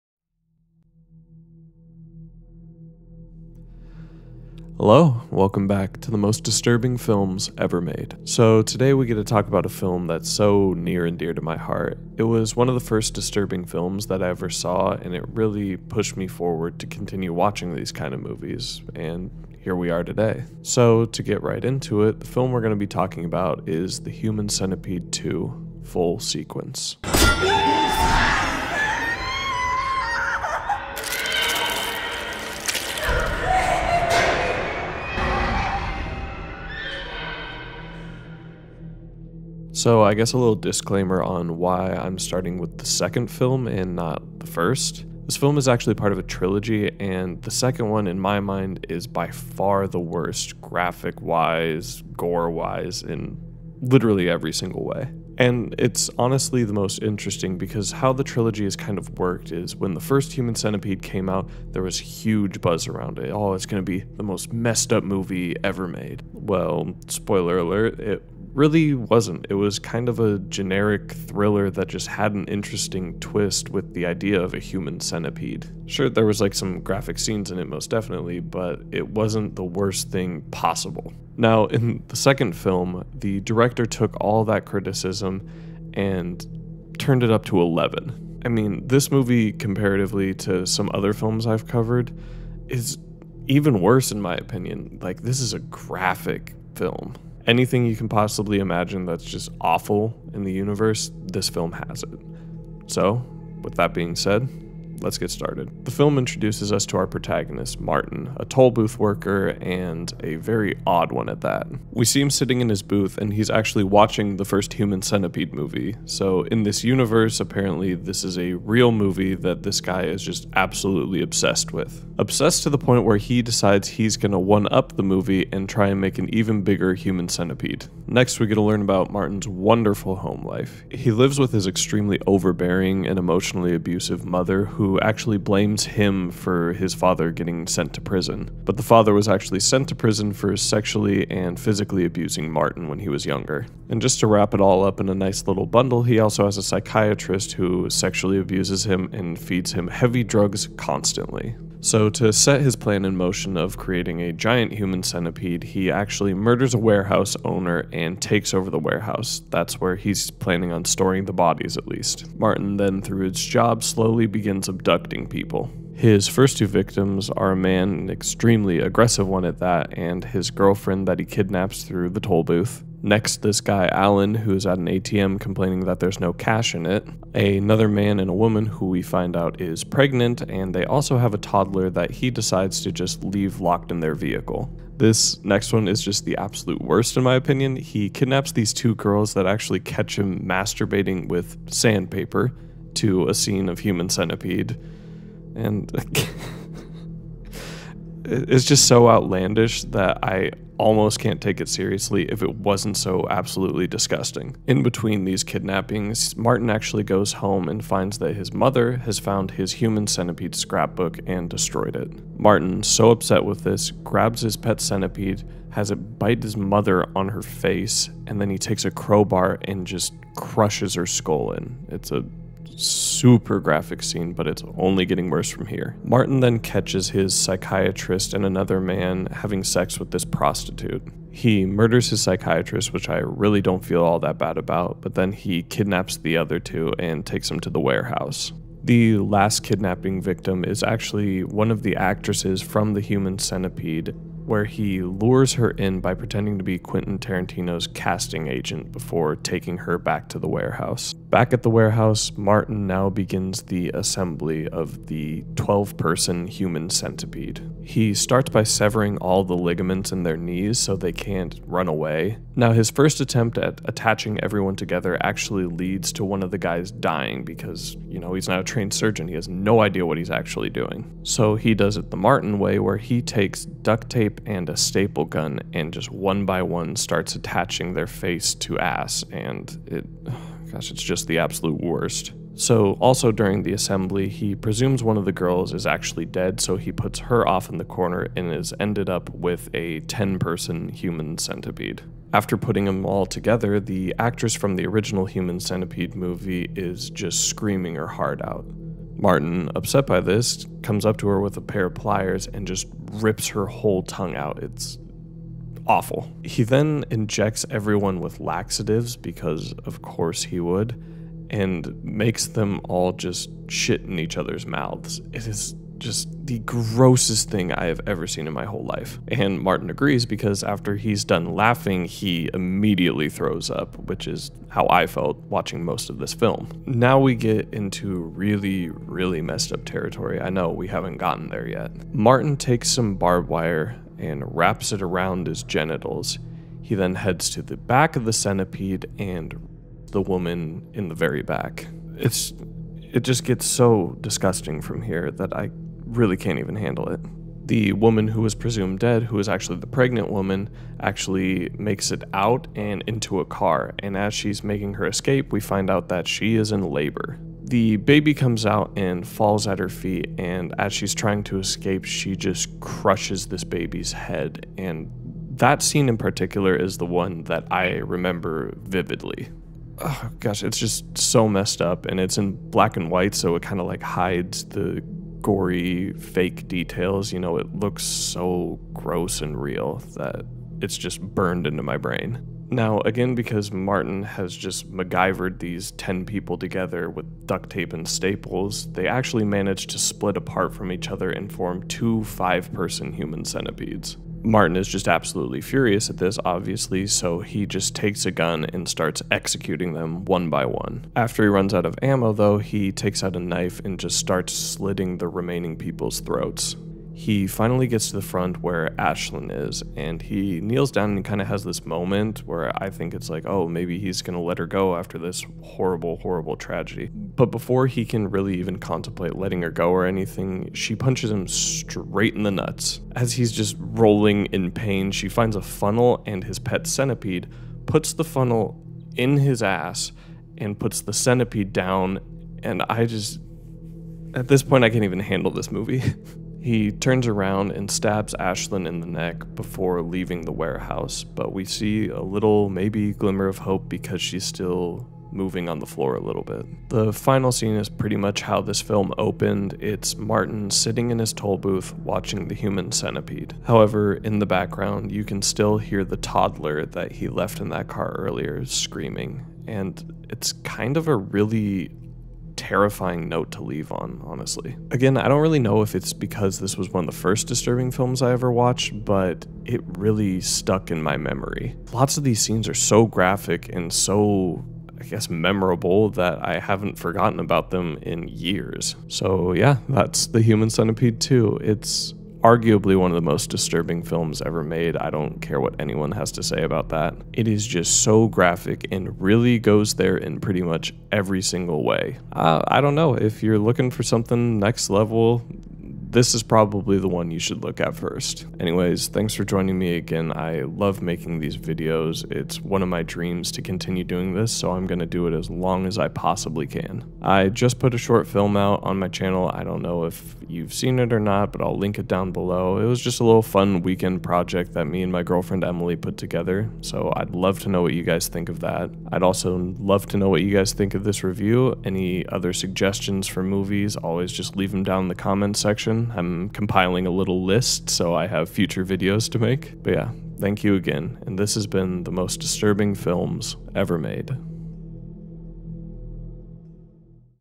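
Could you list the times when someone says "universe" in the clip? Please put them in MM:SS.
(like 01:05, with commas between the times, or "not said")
01:40, 01:56.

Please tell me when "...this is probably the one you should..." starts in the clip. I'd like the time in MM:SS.
08:16.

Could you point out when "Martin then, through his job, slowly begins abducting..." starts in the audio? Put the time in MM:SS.
02:42.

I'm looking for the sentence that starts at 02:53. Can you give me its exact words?
Next, this guy Allen, who is at an ATM complaining that there's no cash in it.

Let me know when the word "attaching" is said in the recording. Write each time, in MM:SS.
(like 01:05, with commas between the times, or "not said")
04:23, 04:37.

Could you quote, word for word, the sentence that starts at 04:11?
Back at the warehouse, Martin now begins the assembly of the 12 person human centipede.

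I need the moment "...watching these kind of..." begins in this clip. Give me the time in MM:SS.
00:17.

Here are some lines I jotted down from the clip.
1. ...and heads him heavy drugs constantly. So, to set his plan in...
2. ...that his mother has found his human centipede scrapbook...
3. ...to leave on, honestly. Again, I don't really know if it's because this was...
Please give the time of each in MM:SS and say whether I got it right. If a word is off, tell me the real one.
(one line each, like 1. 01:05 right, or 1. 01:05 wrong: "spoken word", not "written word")
1. 02:29 wrong: "feeds", not "heads"
2. 03:28 right
3. 07:43 right.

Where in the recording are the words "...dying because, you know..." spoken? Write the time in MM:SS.
04:26.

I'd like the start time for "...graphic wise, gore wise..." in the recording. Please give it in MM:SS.
00:50.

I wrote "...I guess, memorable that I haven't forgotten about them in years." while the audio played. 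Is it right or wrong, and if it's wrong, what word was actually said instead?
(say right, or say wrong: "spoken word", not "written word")
right.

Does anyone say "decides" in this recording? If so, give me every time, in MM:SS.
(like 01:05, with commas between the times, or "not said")
02:03, 03:02.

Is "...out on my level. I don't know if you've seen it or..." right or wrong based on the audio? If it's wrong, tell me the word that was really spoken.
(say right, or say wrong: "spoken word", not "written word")
wrong: "channel", not "level".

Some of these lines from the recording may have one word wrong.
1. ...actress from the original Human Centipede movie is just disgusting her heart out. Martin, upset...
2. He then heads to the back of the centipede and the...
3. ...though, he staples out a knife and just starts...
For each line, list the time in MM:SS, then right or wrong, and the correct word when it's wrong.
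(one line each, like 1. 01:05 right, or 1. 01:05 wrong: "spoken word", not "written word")
1. 04:54 wrong: "screaming", not "disgusting"
2. 05:36 right
3. 06:42 wrong: "takes", not "staples".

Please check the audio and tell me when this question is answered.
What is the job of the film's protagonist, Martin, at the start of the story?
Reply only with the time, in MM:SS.
01:48.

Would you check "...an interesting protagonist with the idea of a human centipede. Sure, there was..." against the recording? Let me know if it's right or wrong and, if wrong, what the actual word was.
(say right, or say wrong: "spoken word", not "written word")
wrong: "twist", not "protagonist".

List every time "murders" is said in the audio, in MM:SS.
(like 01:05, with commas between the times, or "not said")
02:36, 03:51.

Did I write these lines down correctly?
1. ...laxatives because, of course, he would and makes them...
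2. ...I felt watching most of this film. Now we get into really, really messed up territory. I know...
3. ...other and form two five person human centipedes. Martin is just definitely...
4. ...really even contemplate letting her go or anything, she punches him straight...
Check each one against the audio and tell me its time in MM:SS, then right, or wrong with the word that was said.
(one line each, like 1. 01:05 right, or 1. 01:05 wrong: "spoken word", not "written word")
1. 05:08 right
2. 05:24 right
3. 06:31 wrong: "absolutely", not "definitely"
4. 06:58 right.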